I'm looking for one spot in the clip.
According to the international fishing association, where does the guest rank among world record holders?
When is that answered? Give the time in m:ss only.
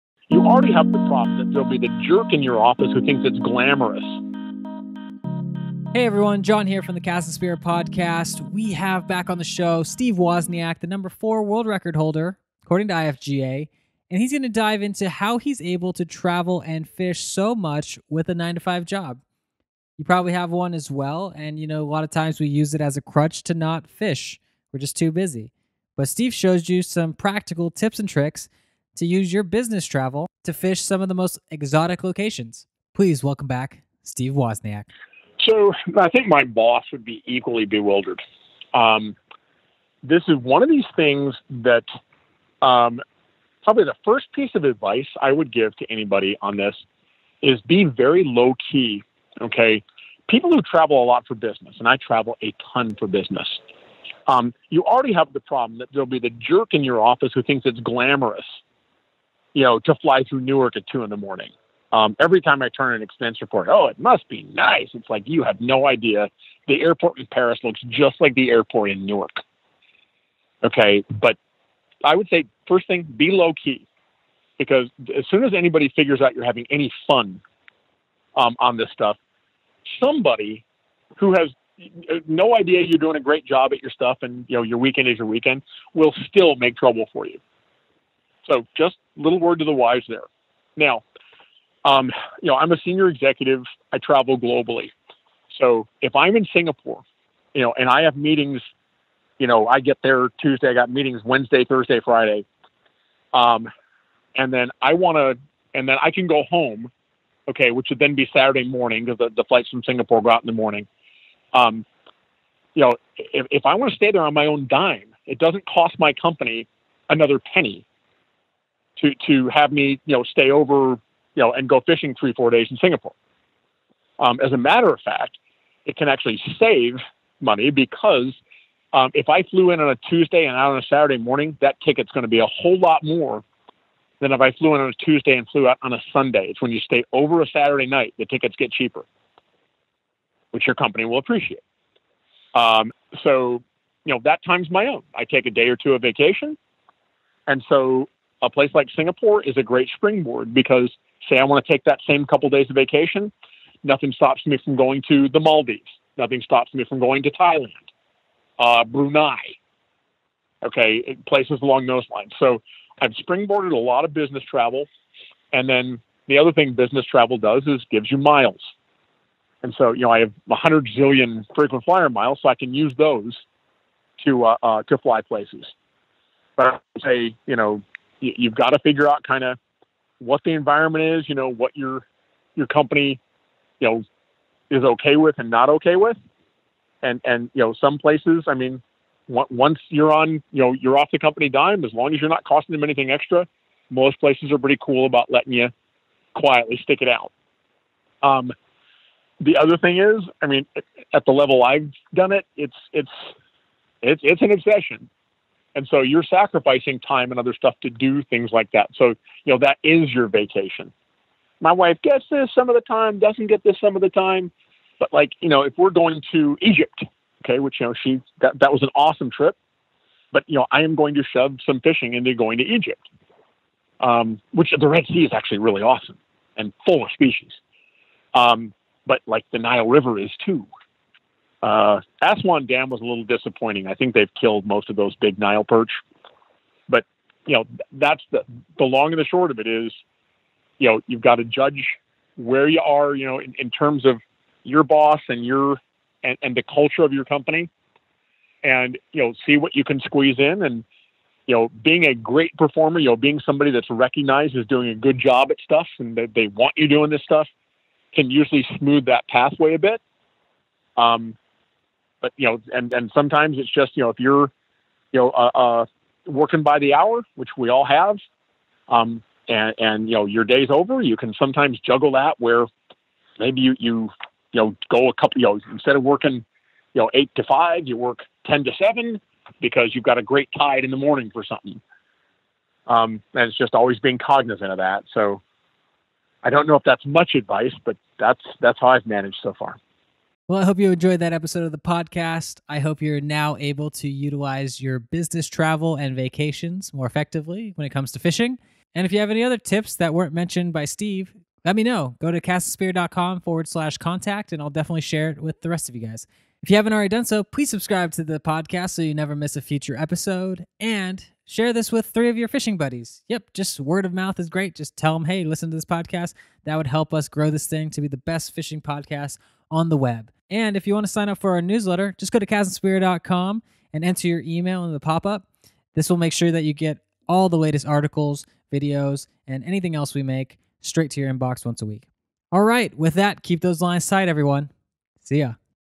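0:10.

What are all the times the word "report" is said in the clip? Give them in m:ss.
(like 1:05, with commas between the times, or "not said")
1:03.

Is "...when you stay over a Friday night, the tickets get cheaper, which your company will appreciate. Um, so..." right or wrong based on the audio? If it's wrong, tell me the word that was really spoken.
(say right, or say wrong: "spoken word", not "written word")
wrong: "Saturday", not "Friday".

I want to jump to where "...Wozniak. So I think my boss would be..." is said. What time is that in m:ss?
0:34.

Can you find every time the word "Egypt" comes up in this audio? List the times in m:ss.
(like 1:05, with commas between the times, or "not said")
3:36, 3:42.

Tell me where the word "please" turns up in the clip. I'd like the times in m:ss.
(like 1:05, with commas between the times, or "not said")
0:32, 5:07.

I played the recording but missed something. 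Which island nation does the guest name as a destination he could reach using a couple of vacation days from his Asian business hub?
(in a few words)
Maldives.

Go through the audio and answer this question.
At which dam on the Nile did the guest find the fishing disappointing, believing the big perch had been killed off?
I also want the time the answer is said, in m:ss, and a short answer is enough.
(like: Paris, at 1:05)
Aswan Dam, at 3:52.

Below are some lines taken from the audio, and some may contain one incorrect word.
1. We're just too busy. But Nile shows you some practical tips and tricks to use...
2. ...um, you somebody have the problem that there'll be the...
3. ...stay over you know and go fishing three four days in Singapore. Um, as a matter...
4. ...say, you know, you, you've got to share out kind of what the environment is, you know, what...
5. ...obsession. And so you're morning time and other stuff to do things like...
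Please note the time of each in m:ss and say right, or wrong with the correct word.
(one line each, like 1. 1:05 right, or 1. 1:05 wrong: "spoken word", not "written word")
1. 0:24 wrong: "Steve", not "Nile"
2. 0:54 wrong: "already", not "somebody"
3. 2:00 right
4. 2:57 wrong: "figure", not "share"
5. 3:24 wrong: "sacrificing", not "morning".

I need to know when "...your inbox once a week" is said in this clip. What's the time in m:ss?
5:31.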